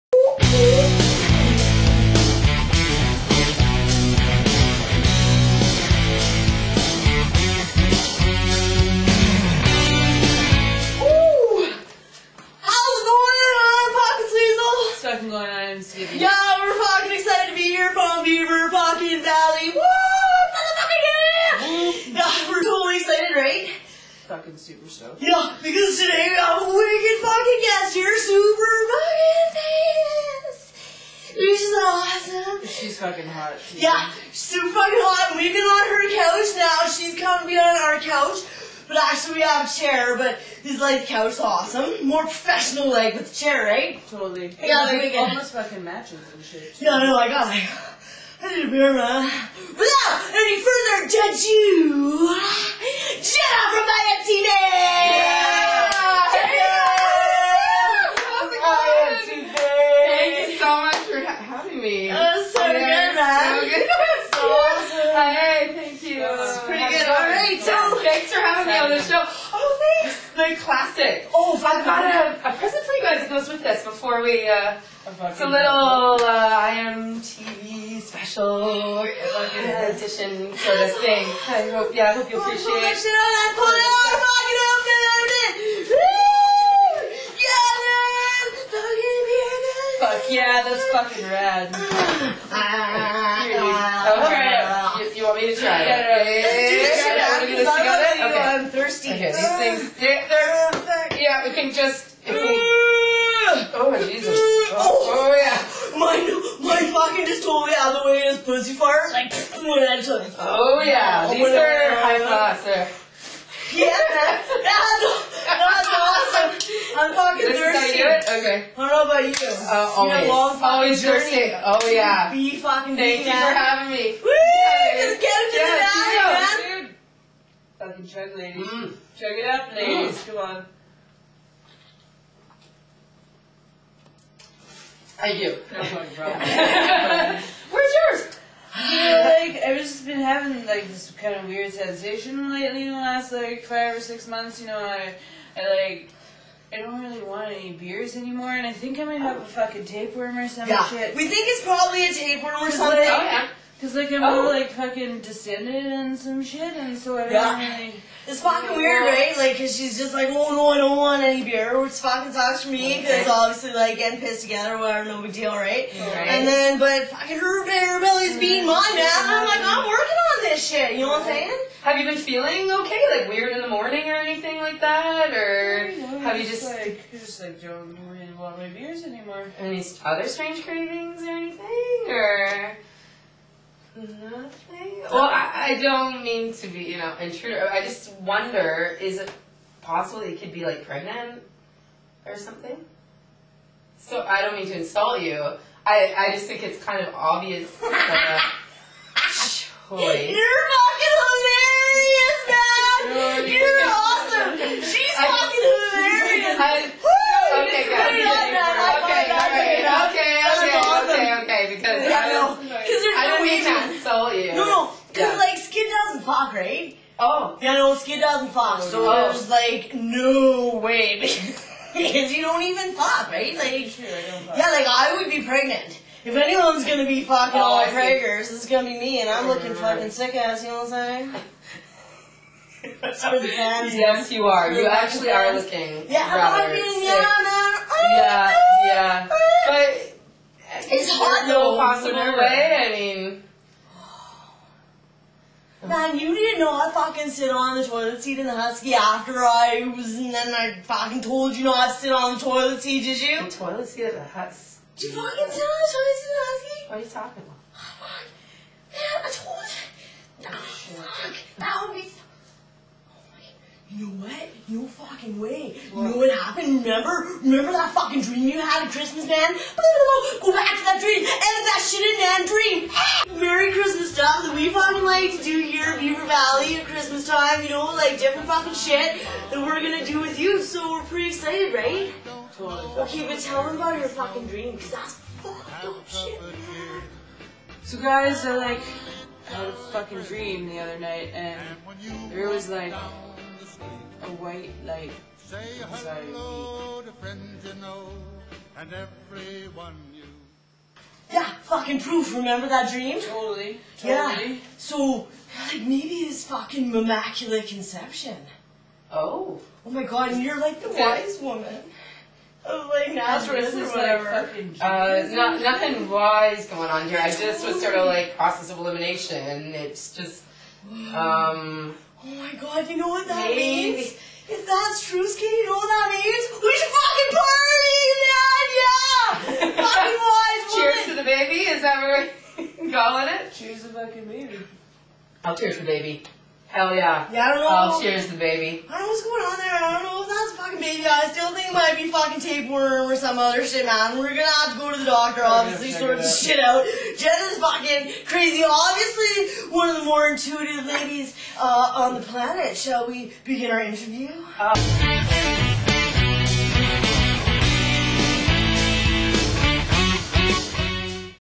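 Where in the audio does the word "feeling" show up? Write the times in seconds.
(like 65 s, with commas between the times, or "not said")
172 s.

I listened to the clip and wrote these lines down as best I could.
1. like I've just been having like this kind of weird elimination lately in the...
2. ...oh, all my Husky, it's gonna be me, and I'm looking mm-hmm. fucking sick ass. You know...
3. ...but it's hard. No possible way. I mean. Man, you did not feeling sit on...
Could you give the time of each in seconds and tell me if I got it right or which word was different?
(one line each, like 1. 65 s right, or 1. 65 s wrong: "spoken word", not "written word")
1. 138 s wrong: "sensation", not "elimination"
2. 227 s wrong: "Kragers", not "Husky"
3. 239 s wrong: "fucking", not "feeling".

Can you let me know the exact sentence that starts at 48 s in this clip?
Rivera, without any further ado, Jenna from my empty name!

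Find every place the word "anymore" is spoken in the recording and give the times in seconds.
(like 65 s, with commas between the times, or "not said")
148 s, 179 s.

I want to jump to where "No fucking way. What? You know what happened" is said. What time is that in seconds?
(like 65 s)
264 s.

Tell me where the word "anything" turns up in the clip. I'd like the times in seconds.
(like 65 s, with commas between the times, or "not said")
174 s, 181 s.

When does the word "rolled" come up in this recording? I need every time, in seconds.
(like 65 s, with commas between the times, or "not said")
not said.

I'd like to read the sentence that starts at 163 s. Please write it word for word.
cause obviously like getting pissed together, whatever, no big deal, right?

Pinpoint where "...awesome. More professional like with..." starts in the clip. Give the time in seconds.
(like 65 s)
41 s.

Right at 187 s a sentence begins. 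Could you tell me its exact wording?
I just wonder, is it possible you could be like pregnant or something?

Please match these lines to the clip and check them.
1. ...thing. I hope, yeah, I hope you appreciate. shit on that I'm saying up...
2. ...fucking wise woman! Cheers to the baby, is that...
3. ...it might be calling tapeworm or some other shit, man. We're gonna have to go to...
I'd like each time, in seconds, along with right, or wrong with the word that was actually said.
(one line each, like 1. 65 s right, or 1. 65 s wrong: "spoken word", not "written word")
1. 81 s wrong: "fucking", not "saying"
2. 329 s right
3. 341 s wrong: "fucking", not "calling".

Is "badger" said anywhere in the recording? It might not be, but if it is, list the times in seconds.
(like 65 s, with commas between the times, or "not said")
not said.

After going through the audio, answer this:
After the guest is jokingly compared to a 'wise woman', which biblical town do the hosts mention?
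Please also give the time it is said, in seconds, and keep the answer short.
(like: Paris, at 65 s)
Nazareth, at 313 s.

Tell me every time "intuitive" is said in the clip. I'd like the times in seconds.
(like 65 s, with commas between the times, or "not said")
350 s.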